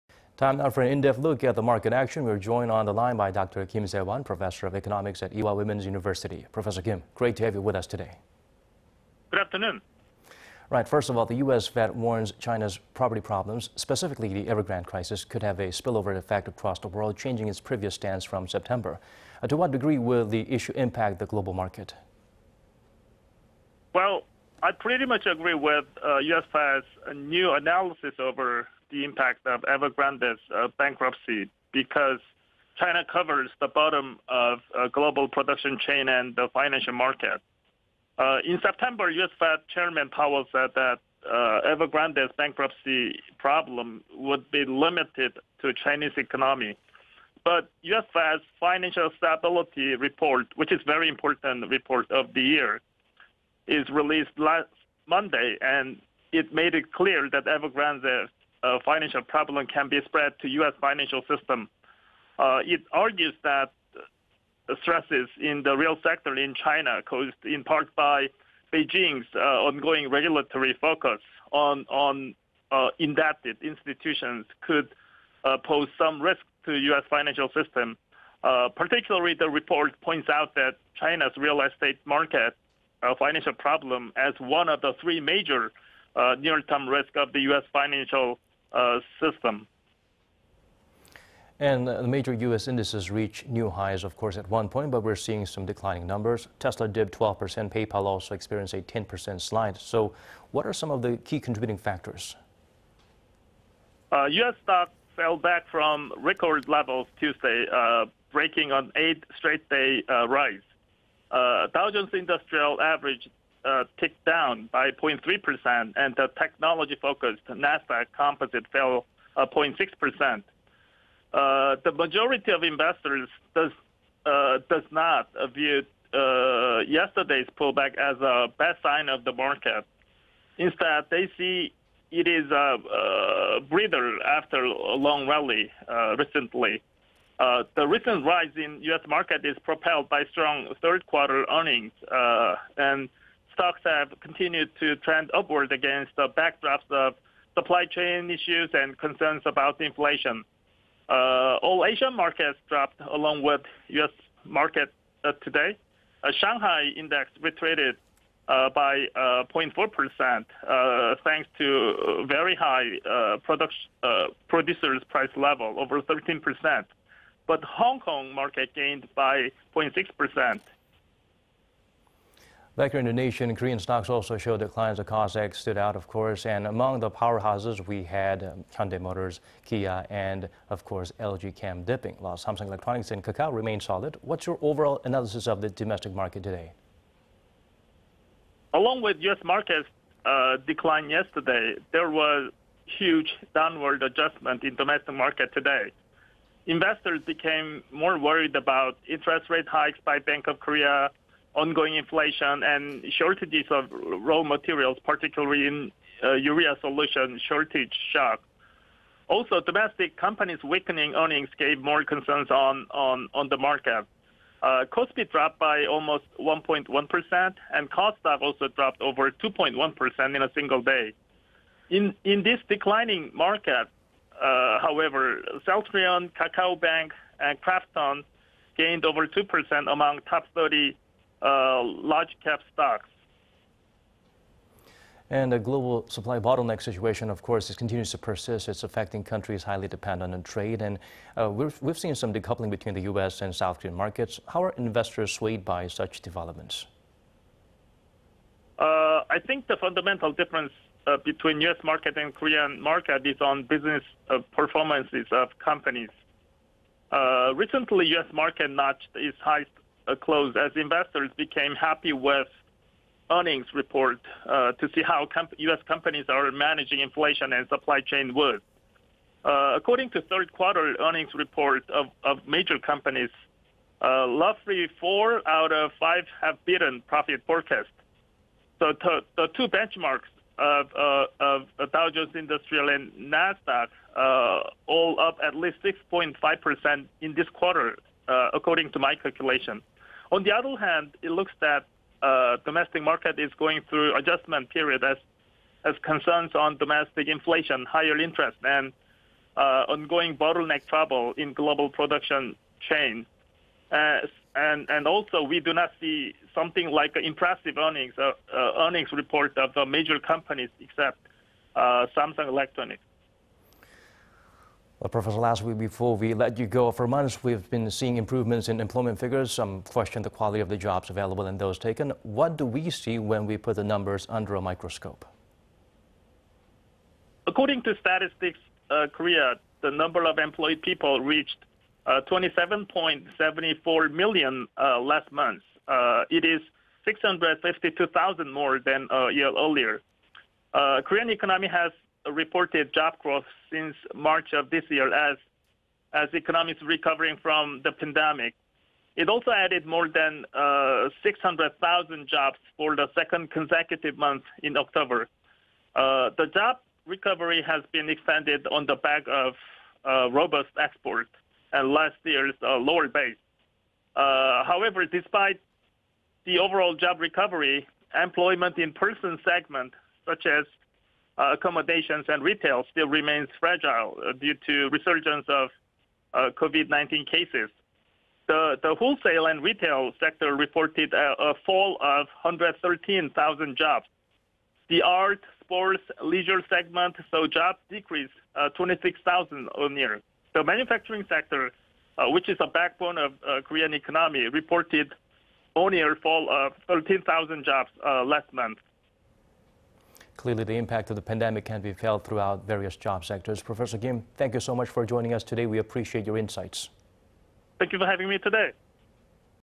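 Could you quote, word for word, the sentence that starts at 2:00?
Uh, uh, the majority of investors does not view yesterday's pullback as a bad sign of the market.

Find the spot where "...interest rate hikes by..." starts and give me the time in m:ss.
3:19.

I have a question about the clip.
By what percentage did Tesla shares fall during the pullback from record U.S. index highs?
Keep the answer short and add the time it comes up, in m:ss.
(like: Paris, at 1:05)
12%, at 1:37.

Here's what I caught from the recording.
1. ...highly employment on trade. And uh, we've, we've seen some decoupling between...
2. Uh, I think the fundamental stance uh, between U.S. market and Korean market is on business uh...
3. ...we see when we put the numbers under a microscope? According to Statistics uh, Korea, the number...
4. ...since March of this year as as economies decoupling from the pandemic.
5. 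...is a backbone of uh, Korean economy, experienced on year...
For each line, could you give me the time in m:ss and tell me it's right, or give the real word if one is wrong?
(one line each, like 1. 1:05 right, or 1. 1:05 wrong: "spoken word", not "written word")
1. 3:59 wrong: "dependent", not "employment"
2. 4:08 wrong: "difference", not "stance"
3. 5:22 right
4. 5:43 wrong: "recovering", not "decoupling"
5. 6:32 wrong: "reported", not "experienced".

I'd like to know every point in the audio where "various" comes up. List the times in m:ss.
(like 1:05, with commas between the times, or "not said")
6:42.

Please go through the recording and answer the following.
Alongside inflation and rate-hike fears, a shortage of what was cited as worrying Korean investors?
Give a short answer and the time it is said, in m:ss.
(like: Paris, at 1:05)
urea solution, at 3:26.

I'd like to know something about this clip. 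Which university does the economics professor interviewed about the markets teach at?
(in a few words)
Ewha Women's University.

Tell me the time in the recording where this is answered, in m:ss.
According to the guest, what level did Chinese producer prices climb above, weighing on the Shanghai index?
2:45.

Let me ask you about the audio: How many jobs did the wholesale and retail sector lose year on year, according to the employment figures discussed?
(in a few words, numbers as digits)
113,000.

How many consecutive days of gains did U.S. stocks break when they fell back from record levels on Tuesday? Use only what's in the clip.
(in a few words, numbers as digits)
8.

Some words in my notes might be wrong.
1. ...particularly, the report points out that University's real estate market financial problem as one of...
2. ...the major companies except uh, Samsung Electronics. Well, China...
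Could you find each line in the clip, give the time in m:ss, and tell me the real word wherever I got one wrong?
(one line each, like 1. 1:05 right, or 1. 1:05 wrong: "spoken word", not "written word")
1. 1:18 wrong: "China", not "University"
2. 5:09 wrong: "Professor", not "China".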